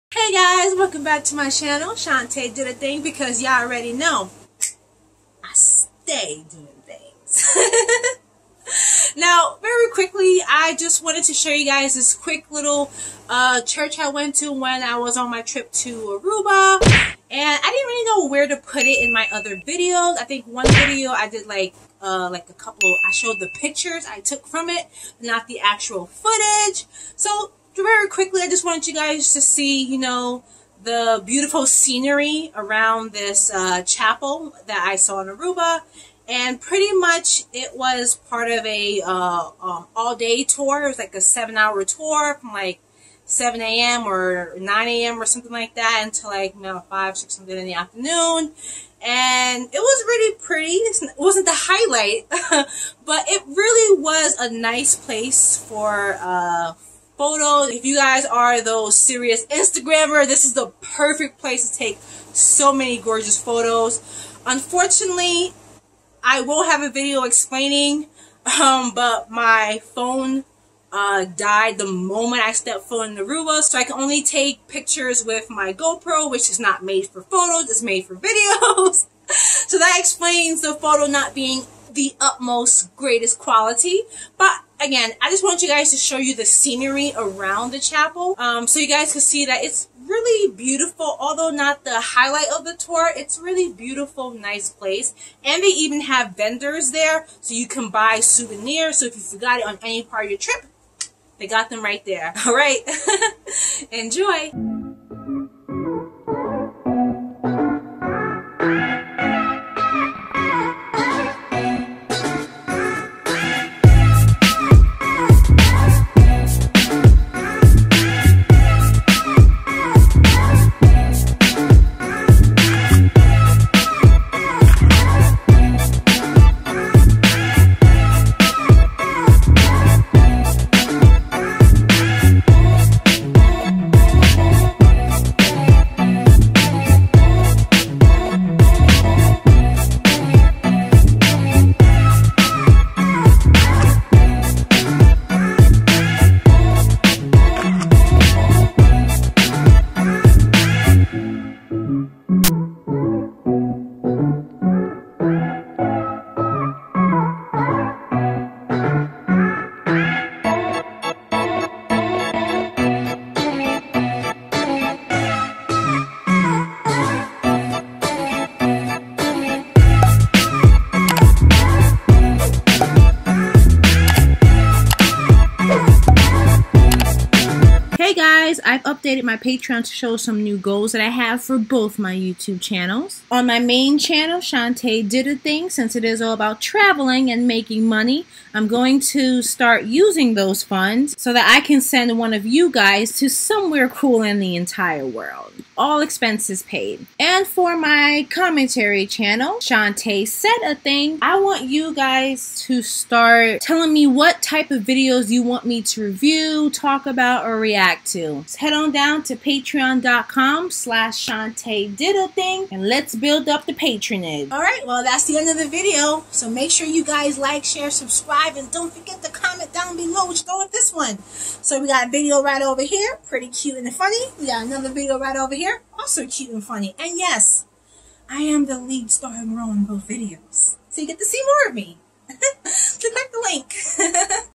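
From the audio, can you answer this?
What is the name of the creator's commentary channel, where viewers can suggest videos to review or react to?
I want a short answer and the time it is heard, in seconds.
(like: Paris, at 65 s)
Shanté Said A Thing, at 199 s.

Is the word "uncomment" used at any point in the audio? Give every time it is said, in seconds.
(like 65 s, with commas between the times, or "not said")
not said.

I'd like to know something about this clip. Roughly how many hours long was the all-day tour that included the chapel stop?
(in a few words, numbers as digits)
7.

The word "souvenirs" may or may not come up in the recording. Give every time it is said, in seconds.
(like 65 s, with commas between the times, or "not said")
98 s.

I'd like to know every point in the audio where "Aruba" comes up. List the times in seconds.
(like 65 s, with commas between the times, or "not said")
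16 s, 35 s, 73 s.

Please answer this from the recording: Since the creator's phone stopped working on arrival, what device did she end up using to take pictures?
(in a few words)
GoPro.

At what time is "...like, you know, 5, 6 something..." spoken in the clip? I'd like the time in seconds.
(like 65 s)
46 s.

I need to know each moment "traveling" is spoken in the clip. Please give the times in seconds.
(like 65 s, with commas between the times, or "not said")
186 s.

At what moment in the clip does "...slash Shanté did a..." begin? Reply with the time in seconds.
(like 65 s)
210 s.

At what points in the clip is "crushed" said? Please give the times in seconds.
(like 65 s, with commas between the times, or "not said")
not said.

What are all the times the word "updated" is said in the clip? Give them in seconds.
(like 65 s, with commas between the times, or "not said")
178 s.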